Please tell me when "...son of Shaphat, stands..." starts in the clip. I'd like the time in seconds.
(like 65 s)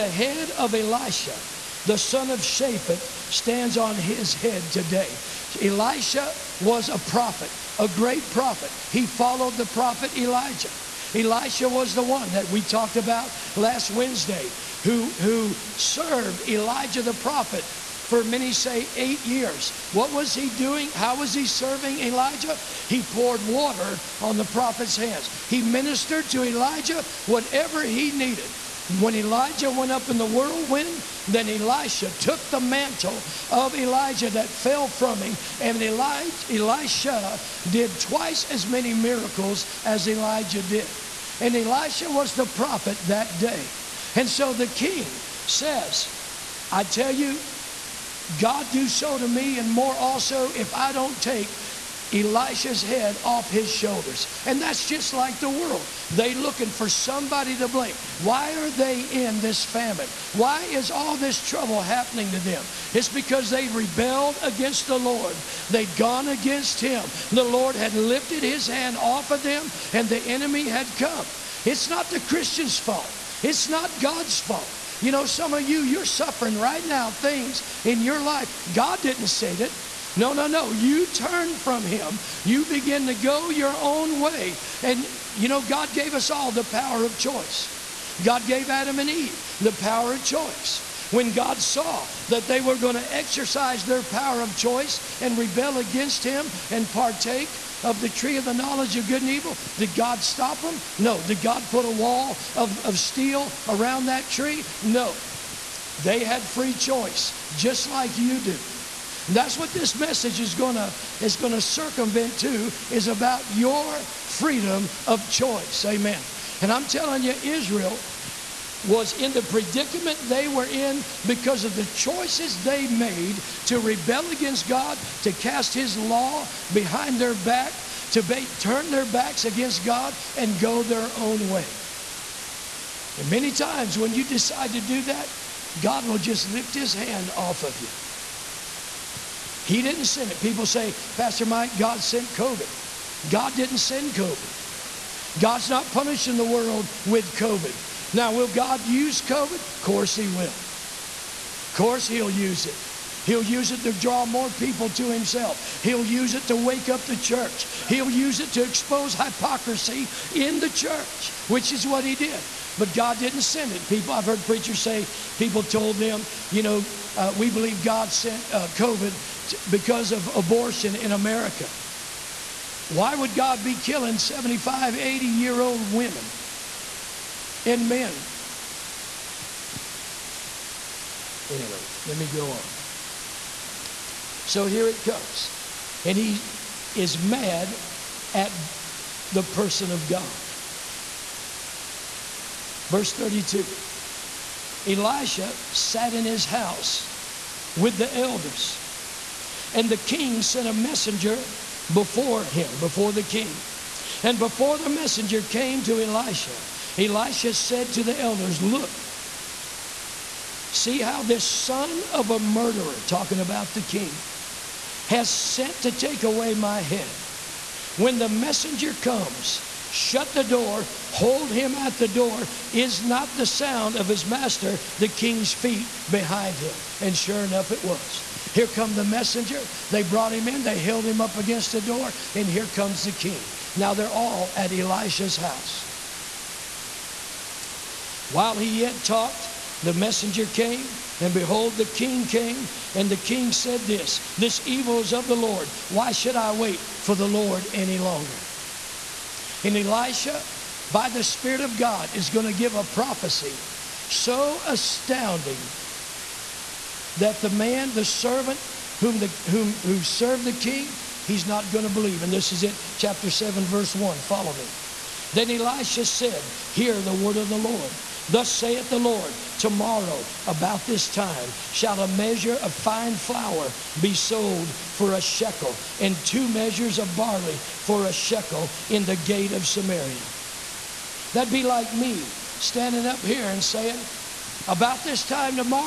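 1 s.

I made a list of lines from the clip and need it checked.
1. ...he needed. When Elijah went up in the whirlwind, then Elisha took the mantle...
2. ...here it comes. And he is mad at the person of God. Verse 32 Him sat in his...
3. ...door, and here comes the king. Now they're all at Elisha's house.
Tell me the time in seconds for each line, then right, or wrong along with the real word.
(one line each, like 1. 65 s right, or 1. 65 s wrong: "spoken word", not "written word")
1. 27 s right
2. 184 s wrong: "Elisha", not "Him"
3. 231 s right.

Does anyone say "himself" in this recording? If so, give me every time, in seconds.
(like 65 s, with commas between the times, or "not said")
155 s.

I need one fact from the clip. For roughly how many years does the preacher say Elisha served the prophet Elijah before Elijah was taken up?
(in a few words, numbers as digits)
8.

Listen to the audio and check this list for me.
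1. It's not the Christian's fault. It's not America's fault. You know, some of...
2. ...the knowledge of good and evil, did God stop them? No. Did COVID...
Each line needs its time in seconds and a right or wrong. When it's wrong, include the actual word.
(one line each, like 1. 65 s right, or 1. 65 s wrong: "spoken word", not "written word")
1. 71 s wrong: "God", not "America"
2. 98 s wrong: "God", not "COVID".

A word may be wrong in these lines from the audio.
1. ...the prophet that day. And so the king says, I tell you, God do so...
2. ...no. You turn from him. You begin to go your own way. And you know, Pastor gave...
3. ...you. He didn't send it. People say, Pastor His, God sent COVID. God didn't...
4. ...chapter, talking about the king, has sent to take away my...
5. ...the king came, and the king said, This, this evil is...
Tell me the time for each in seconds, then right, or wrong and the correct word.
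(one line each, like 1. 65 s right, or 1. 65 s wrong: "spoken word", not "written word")
1. 42 s right
2. 80 s wrong: "God", not "Pastor"
3. 137 s wrong: "Mike", not "His"
4. 212 s wrong: "murderer", not "chapter"
5. 241 s right.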